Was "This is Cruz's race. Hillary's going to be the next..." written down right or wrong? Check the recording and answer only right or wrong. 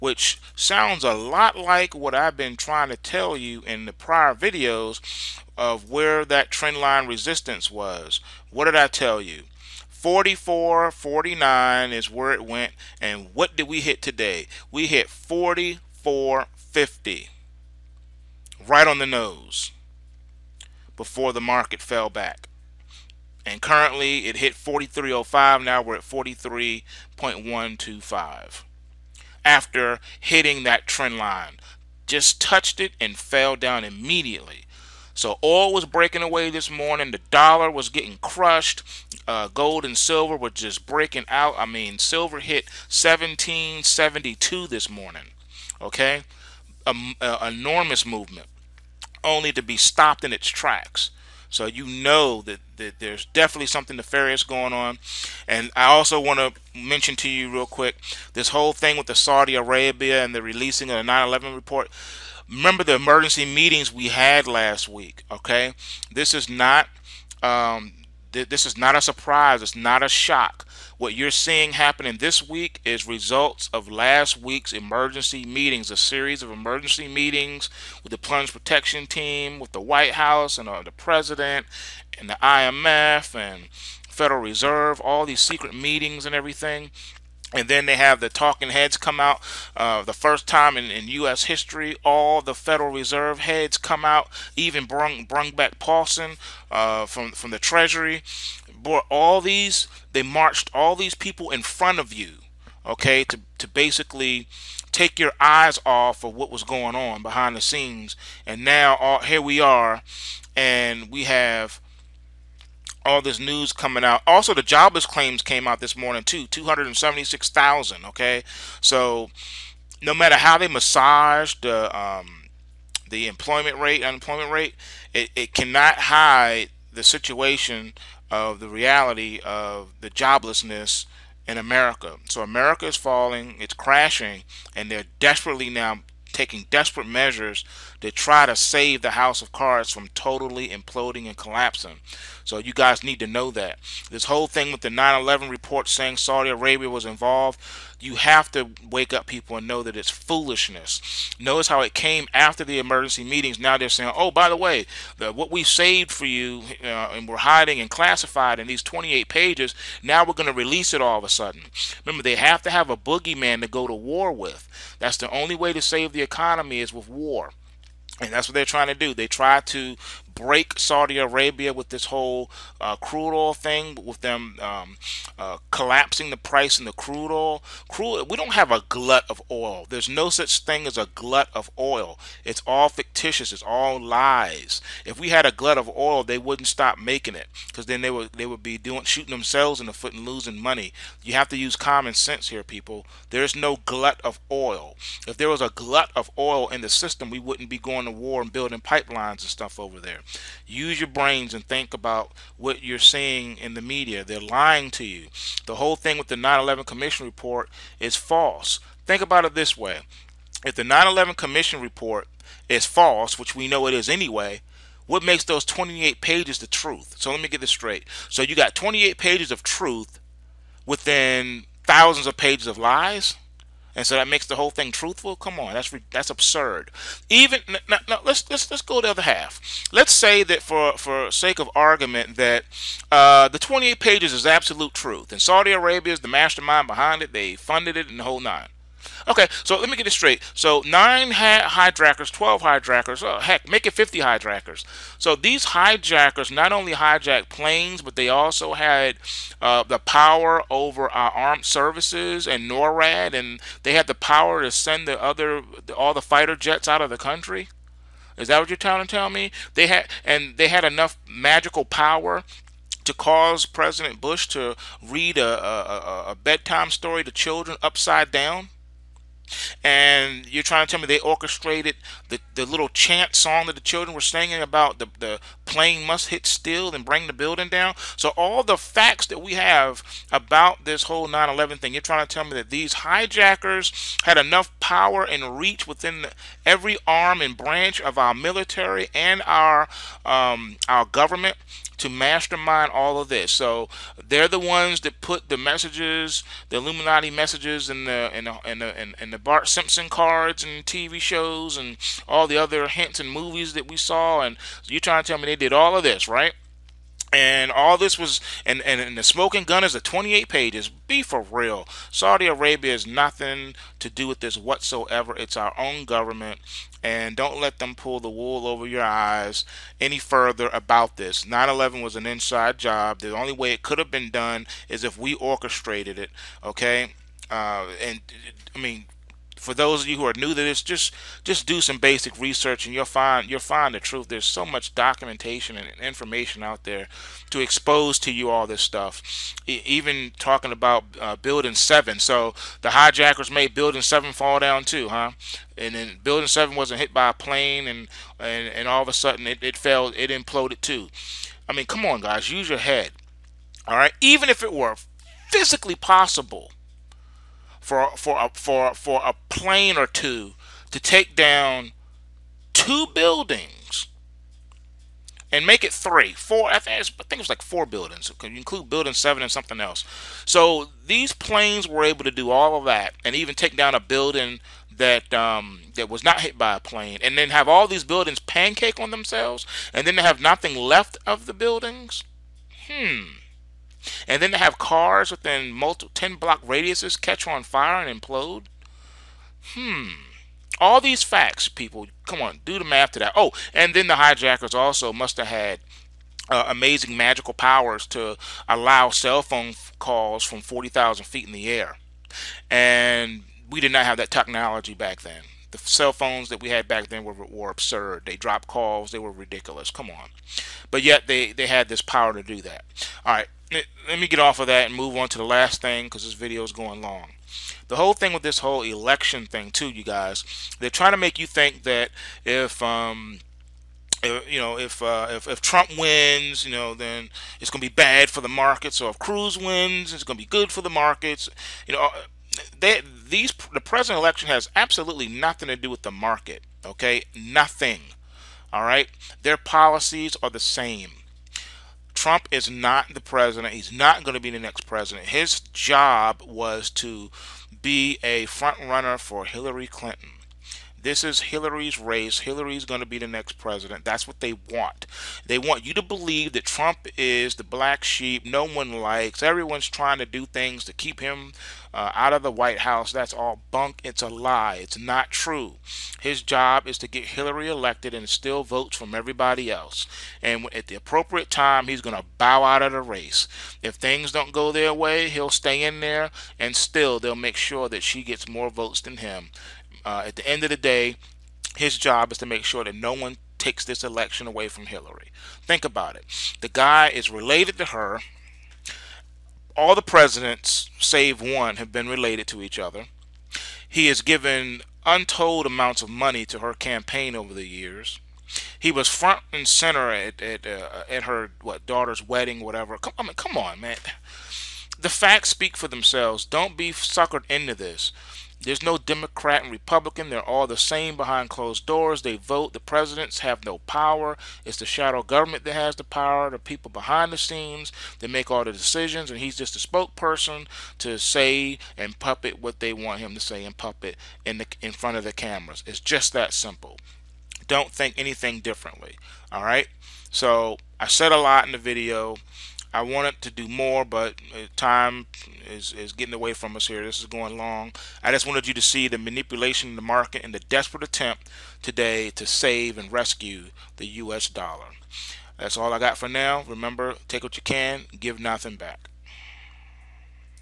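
wrong.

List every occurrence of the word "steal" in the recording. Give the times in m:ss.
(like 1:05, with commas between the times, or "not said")
7:48.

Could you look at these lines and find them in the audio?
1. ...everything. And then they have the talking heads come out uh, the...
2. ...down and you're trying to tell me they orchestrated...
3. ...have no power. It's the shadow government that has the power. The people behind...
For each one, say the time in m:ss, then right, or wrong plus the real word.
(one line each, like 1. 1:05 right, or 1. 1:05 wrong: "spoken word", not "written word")
1. 1:26 right
2. 4:28 right
3. 8:33 right.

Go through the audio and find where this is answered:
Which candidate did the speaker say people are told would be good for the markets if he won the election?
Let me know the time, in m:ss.
7:09.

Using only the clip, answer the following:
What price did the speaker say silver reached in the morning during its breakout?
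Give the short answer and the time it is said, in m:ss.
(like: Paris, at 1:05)
17.72, at 0:42.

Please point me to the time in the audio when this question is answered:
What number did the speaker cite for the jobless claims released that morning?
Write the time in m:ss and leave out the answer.
1:56.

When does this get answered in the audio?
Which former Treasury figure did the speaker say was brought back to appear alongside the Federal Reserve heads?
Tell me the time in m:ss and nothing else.
1:35.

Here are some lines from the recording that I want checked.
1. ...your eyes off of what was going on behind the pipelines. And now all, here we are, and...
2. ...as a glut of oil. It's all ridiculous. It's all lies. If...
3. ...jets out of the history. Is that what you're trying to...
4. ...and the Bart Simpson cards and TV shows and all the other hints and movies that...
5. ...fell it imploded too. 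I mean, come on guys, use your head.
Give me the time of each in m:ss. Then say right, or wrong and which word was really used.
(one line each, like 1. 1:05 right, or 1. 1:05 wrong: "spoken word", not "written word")
1. 1:45 wrong: "scenes", not "pipelines"
2. 3:00 wrong: "fictitious", not "ridiculous"
3. 4:16 wrong: "country", not "history"
4. 4:59 right
5. 5:49 right.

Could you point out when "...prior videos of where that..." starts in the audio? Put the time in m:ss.
0:03.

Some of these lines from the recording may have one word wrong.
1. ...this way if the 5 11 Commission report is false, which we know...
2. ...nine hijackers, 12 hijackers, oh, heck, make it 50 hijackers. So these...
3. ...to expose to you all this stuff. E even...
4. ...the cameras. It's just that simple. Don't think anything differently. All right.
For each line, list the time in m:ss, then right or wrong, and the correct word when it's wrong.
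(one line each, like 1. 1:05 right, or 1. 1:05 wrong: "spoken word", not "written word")
1. 3:29 wrong: "9", not "5"
2. 4:00 right
3. 5:37 right
4. 8:45 right.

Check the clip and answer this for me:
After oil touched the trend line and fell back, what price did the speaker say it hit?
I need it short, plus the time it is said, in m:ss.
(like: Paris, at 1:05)
43.05, at 0:24.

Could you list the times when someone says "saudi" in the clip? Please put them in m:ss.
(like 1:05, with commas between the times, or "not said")
0:59, 2:26, 2:50, 3:55, 5:12.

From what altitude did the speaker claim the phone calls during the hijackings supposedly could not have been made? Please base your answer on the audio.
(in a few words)
40,000 feet.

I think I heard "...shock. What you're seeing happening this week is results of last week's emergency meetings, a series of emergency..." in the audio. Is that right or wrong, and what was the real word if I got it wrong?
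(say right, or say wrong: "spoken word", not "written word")
right.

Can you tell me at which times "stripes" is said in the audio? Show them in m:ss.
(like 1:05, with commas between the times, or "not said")
not said.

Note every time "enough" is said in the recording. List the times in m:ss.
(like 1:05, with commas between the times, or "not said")
4:20, 4:44.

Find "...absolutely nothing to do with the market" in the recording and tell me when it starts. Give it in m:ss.
7:14.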